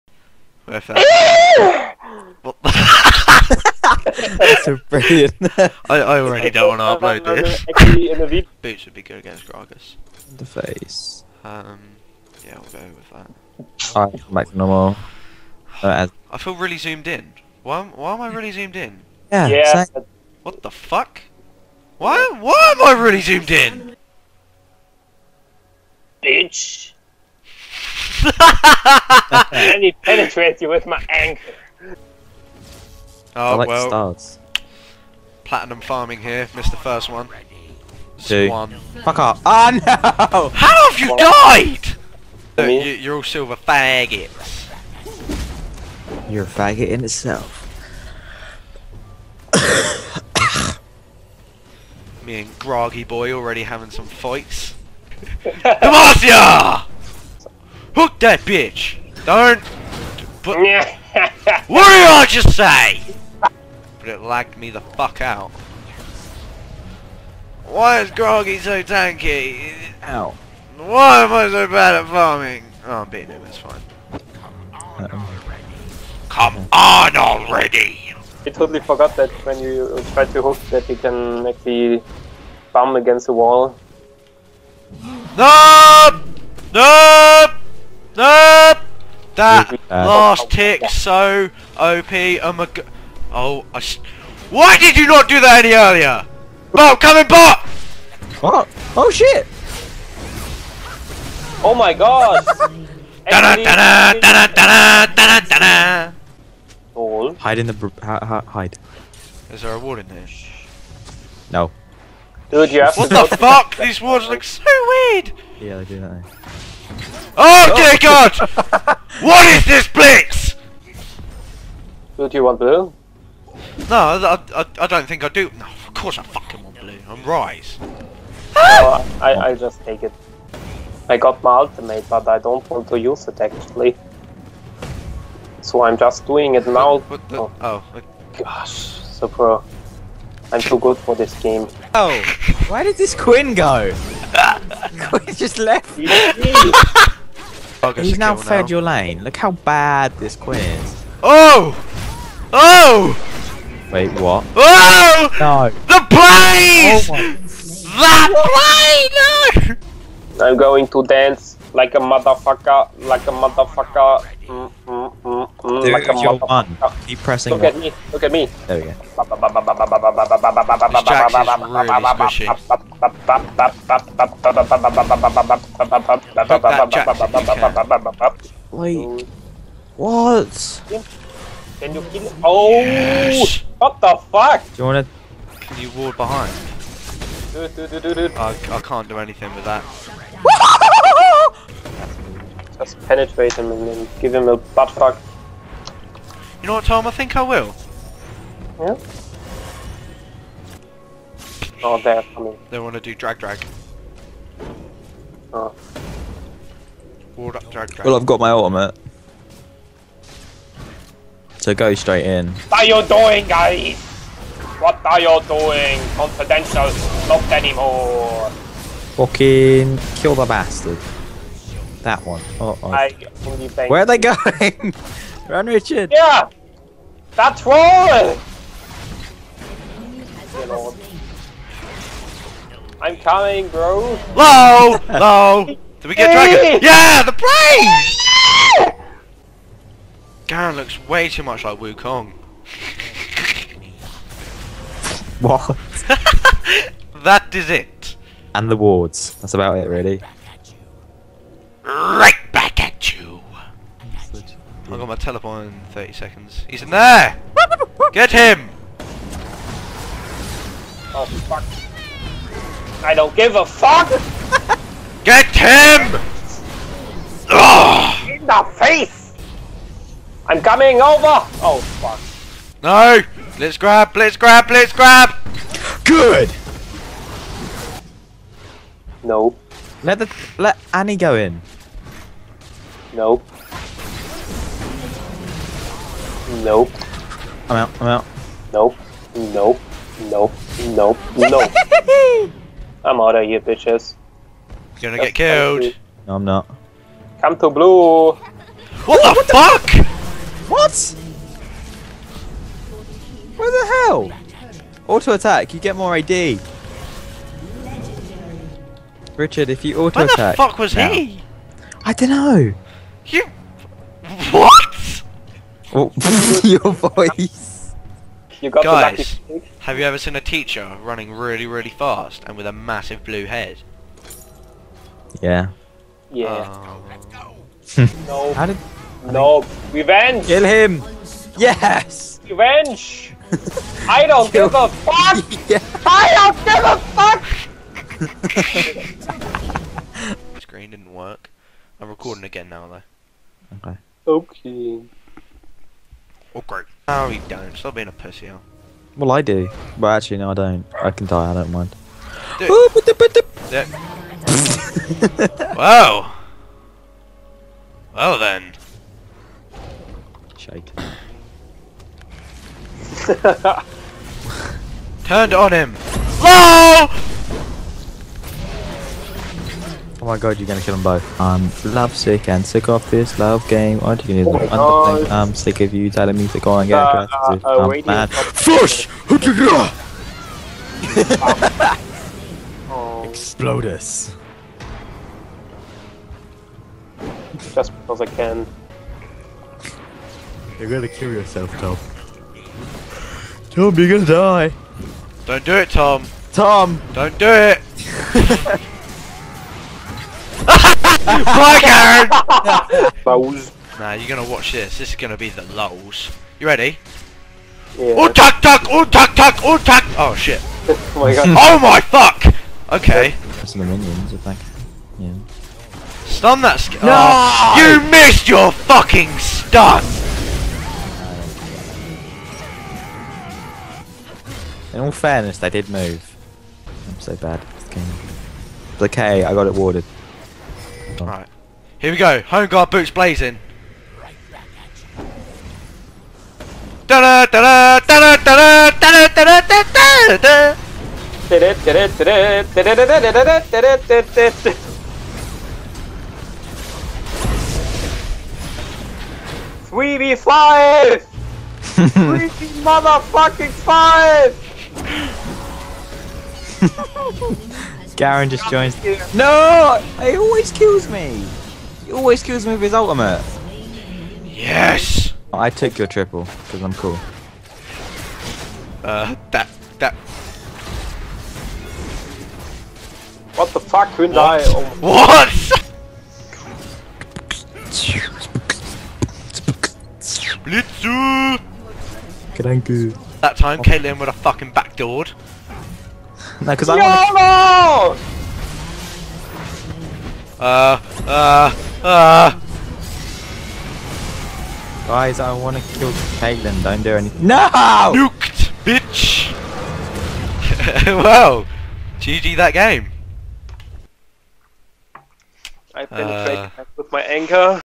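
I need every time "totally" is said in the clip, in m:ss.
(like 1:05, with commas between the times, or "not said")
1:18.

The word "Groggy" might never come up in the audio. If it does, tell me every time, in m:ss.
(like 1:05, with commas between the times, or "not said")
0:52, 1:08.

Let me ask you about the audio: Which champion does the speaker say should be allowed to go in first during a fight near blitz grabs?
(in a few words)
Annie.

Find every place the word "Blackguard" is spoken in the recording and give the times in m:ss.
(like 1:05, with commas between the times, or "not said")
6:41.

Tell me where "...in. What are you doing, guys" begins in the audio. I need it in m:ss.
3:32.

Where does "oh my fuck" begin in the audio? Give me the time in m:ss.
6:51.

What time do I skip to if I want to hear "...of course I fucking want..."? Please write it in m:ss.
2:05.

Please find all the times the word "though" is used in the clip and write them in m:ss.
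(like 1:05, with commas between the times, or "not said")
5:42.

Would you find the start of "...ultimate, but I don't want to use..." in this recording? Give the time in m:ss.
2:11.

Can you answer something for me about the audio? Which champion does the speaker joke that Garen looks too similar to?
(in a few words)
Wukong.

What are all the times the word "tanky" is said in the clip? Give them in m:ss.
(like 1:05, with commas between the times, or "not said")
1:08.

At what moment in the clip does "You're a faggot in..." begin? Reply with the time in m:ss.
0:46.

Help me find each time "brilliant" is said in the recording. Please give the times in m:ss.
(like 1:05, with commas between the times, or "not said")
0:04.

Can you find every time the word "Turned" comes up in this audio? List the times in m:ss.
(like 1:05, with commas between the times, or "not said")
6:05.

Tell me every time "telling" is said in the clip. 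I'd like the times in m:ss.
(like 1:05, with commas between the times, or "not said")
6:16.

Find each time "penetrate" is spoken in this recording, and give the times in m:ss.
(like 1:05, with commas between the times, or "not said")
0:30, 3:13, 8:26.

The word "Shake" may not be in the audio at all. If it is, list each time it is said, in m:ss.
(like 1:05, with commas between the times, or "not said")
6:00.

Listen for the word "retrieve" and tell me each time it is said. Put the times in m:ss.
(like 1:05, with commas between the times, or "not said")
not said.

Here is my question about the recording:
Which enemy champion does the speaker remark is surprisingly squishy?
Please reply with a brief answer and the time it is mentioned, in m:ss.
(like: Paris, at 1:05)
Jax, at 2:49.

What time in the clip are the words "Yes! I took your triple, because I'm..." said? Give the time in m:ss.
7:44.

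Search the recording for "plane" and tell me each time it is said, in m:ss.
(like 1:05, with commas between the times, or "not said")
2:36, 3:57.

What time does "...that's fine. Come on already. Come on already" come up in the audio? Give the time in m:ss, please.
1:13.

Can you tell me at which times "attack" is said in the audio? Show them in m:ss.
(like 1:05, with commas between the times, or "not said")
5:05, 5:10.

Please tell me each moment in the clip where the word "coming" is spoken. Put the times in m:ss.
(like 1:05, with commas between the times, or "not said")
1:36, 3:22, 3:53, 4:30.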